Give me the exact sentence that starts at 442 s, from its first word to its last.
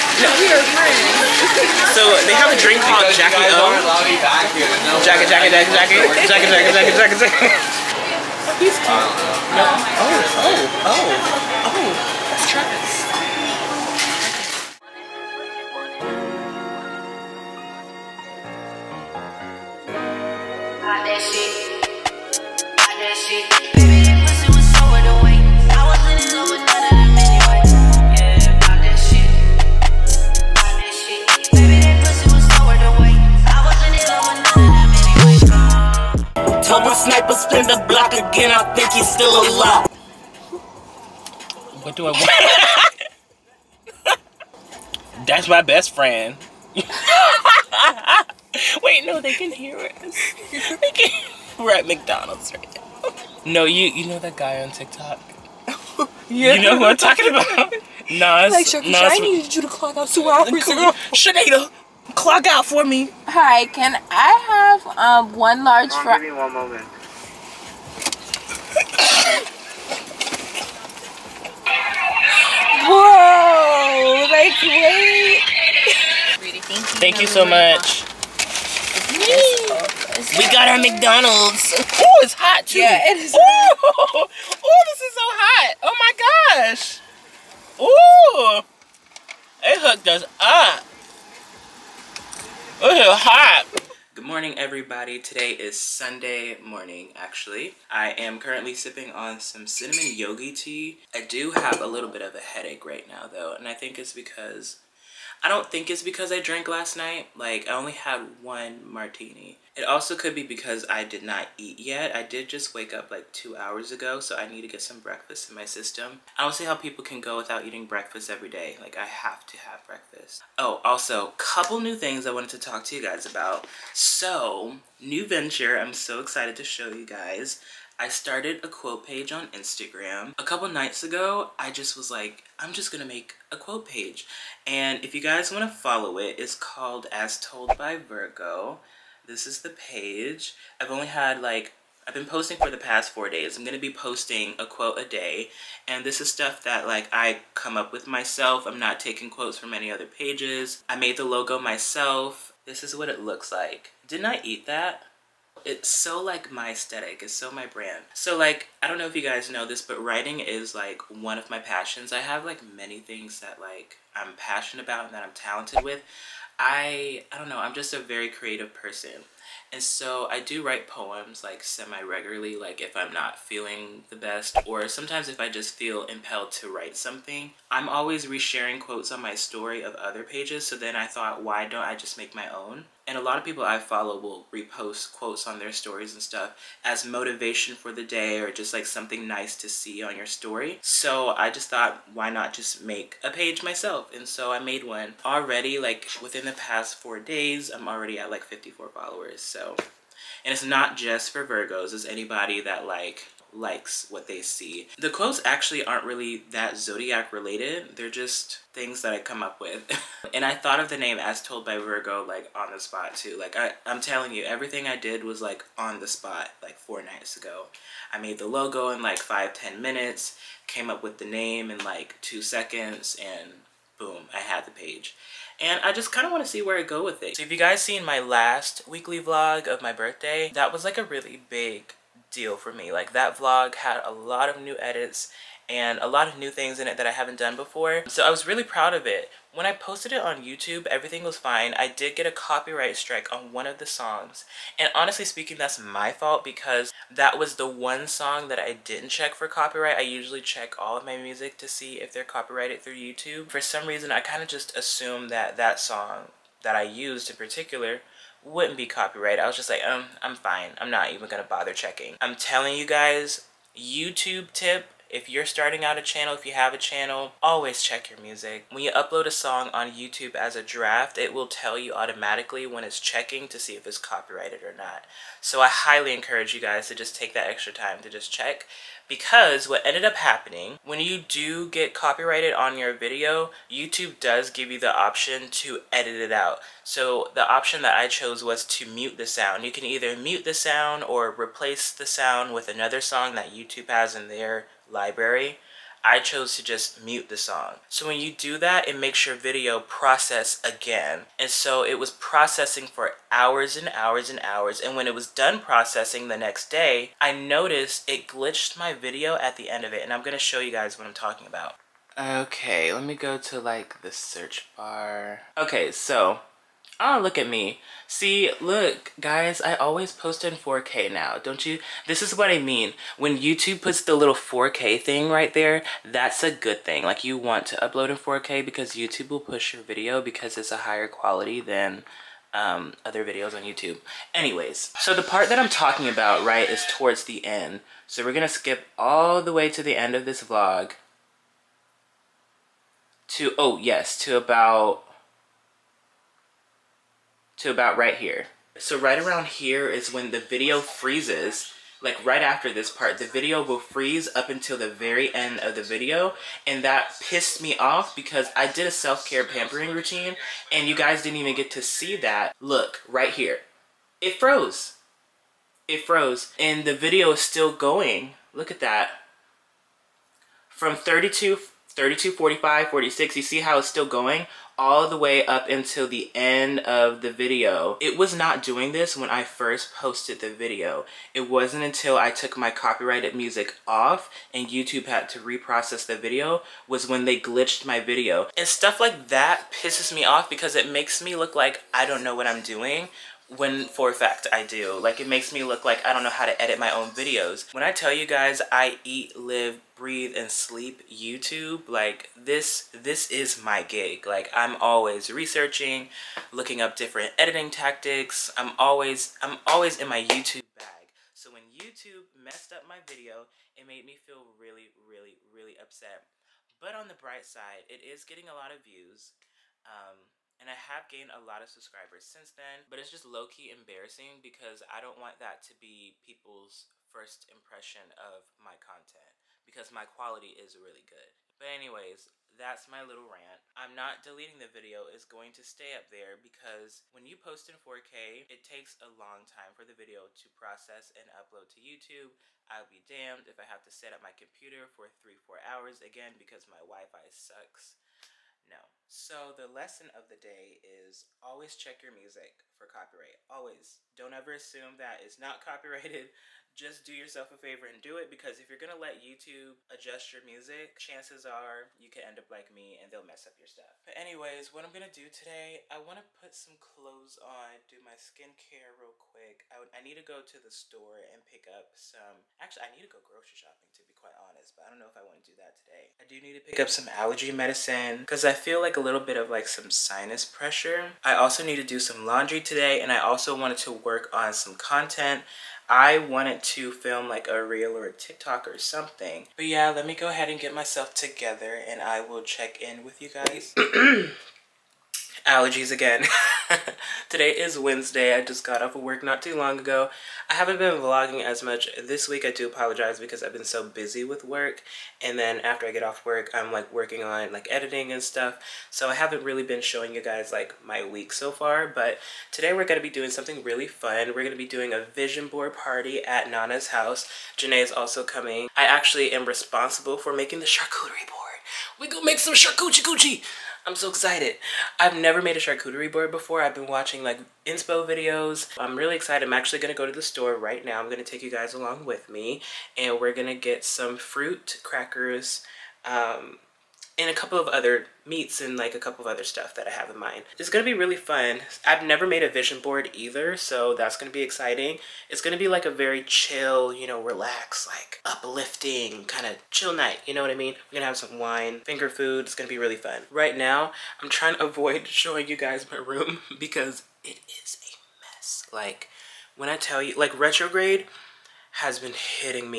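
I'll be damned if I have to set up my computer for three, four hours again because my Wi-Fi sucks.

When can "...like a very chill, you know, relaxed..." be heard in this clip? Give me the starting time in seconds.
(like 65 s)
545 s.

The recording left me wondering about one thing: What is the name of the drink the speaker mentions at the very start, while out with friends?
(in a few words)
Jackie O.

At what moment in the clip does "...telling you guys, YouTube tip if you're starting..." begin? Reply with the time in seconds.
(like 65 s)
262 s.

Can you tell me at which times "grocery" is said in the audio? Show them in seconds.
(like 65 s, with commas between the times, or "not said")
473 s.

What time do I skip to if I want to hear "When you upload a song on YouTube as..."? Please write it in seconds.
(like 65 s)
268 s.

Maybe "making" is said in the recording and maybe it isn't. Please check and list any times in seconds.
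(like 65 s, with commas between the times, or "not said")
520 s.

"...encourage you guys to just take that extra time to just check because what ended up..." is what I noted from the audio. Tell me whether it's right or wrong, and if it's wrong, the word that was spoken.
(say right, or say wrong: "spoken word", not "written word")
right.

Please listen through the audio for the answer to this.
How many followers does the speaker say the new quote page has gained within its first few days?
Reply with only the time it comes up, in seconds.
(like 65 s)
198 s.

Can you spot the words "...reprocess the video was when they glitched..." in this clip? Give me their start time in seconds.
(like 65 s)
385 s.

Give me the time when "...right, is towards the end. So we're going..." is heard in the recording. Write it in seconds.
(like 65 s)
336 s.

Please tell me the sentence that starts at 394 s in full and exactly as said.
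Like it makes me look like I don't know how to edit my own videos.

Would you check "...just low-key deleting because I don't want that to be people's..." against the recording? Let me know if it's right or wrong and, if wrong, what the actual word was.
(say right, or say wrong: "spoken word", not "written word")
wrong: "embarrassing", not "deleting".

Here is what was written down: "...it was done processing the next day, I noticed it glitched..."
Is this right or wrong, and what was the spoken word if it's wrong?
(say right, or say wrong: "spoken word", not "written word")
right.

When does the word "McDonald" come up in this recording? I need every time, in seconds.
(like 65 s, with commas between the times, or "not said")
51 s, 80 s.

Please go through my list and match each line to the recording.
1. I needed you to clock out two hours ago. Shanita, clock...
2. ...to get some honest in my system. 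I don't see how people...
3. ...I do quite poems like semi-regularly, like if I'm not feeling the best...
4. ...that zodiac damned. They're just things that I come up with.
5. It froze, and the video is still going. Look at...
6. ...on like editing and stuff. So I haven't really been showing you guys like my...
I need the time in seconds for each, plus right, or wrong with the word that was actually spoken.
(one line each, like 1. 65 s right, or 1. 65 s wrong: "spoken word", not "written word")
1. 59 s right
2. 114 s wrong: "breakfast", not "honest"
3. 170 s wrong: "write", not "quite"
4. 206 s wrong: "related", not "damned"
5. 365 s right
6. 507 s right.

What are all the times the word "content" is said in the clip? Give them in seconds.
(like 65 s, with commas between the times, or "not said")
428 s, 484 s.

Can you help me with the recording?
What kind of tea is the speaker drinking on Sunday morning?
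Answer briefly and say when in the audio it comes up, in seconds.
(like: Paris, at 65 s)
cinnamon yogi tea, at 99 s.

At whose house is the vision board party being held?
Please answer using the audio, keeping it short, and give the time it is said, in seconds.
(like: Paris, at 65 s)
Nana's house, at 516 s.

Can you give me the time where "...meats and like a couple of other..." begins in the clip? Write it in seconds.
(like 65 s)
538 s.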